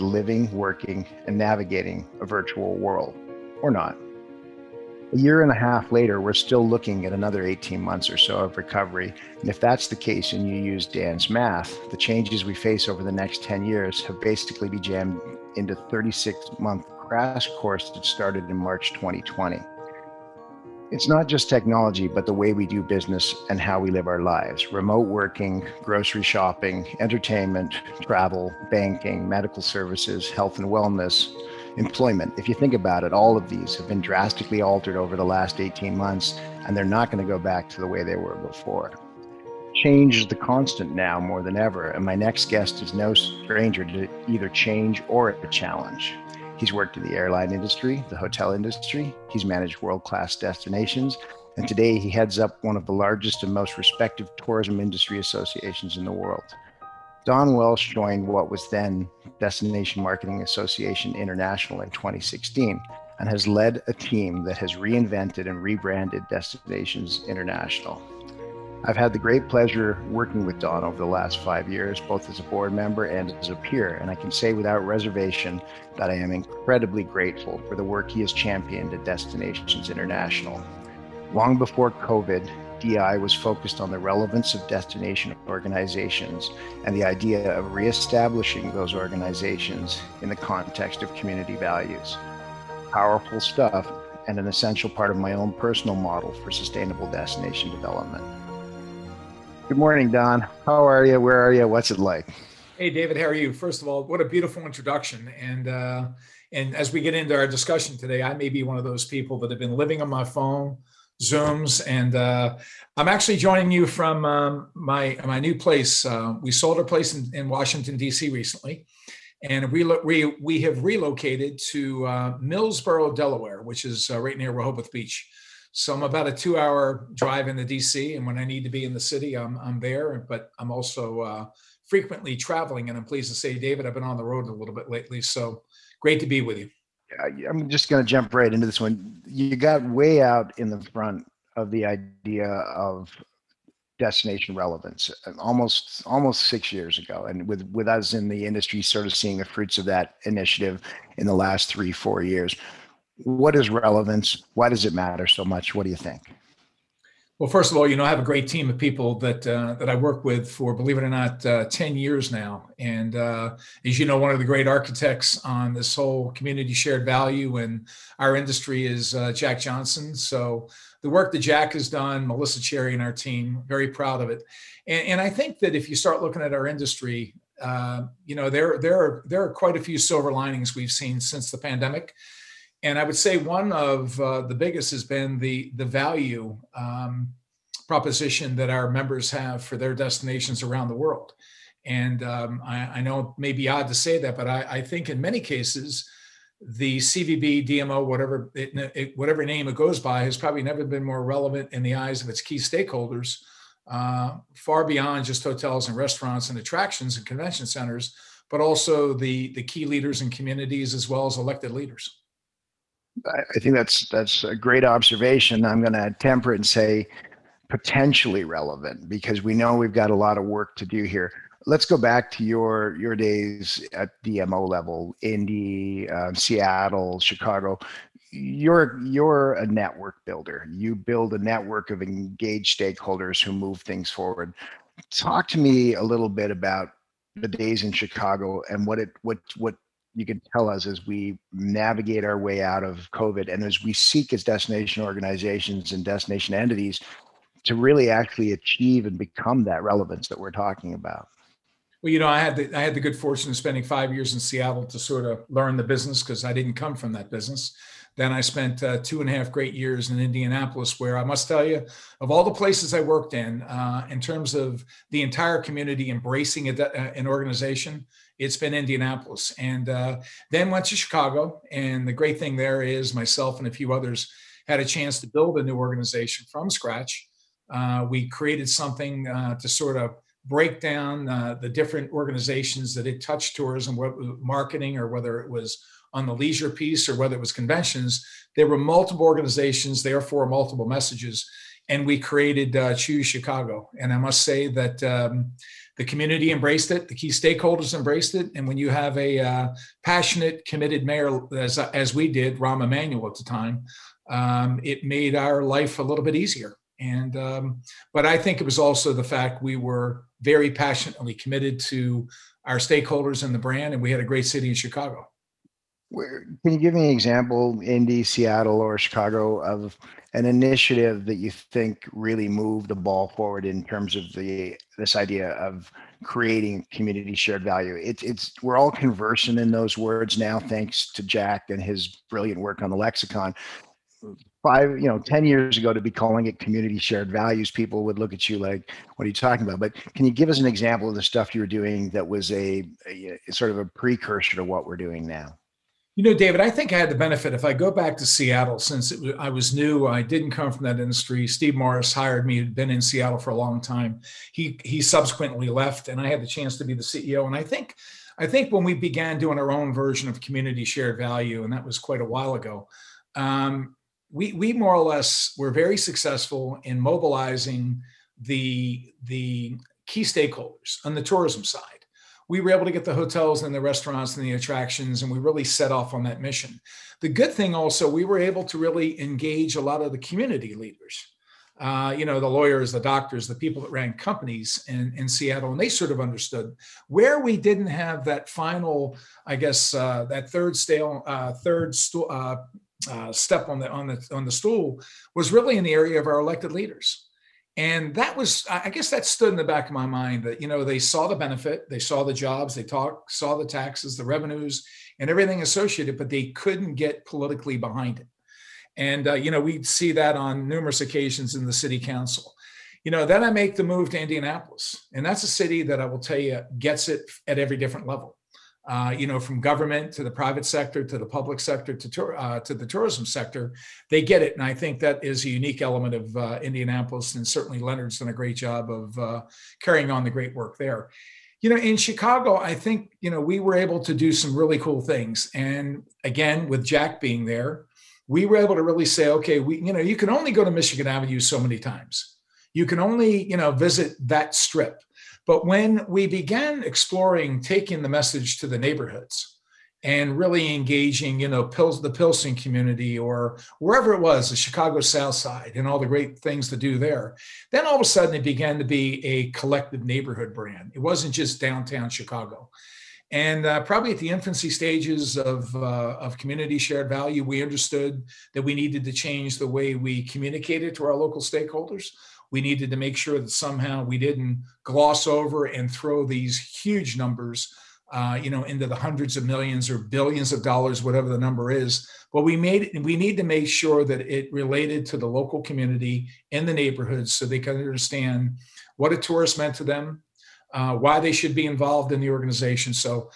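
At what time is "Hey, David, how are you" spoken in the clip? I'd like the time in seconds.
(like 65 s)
102 s.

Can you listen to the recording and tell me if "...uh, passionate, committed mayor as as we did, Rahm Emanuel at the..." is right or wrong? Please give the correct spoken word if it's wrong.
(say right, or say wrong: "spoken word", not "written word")
right.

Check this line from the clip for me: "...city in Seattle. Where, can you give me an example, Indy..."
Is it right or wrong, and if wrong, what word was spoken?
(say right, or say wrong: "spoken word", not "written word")
wrong: "Chicago", not "Seattle".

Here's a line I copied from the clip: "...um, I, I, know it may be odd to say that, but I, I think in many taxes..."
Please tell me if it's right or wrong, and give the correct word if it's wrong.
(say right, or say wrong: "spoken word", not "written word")
wrong: "cases", not "taxes".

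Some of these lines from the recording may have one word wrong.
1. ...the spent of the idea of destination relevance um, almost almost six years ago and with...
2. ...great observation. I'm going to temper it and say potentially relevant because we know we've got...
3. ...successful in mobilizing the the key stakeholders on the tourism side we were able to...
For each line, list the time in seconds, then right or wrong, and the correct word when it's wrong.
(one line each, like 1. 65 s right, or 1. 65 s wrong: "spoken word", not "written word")
1. 140 s wrong: "front", not "spent"
2. 214 s right
3. 365 s right.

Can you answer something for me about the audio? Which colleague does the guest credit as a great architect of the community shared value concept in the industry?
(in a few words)
Jack Johnson.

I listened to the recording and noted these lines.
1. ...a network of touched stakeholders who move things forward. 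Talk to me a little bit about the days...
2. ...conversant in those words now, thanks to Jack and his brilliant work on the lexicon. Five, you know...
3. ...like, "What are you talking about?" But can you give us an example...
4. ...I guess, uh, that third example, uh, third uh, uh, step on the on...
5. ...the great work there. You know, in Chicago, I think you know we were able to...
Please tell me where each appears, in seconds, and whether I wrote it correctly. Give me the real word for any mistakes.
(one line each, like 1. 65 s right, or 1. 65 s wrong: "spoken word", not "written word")
1. 231 s wrong: "engaged", not "touched"
2. 328 s right
3. 338 s right
4. 389 s wrong: "stale", not "example"
5. 430 s right.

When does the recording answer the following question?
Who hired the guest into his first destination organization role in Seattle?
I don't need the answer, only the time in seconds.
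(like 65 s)
351 s.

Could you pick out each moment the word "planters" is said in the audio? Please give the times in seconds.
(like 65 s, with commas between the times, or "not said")
not said.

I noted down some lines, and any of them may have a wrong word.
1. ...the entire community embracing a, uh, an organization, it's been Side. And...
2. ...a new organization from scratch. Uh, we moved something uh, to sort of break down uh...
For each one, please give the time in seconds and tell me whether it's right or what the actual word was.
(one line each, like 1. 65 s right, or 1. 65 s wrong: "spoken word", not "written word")
1. 265 s wrong: "Indianapolis", not "Side"
2. 275 s wrong: "created", not "moved".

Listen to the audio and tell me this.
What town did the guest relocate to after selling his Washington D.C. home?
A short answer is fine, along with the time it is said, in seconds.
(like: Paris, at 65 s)
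Millsboro, Delaware, at 122 s.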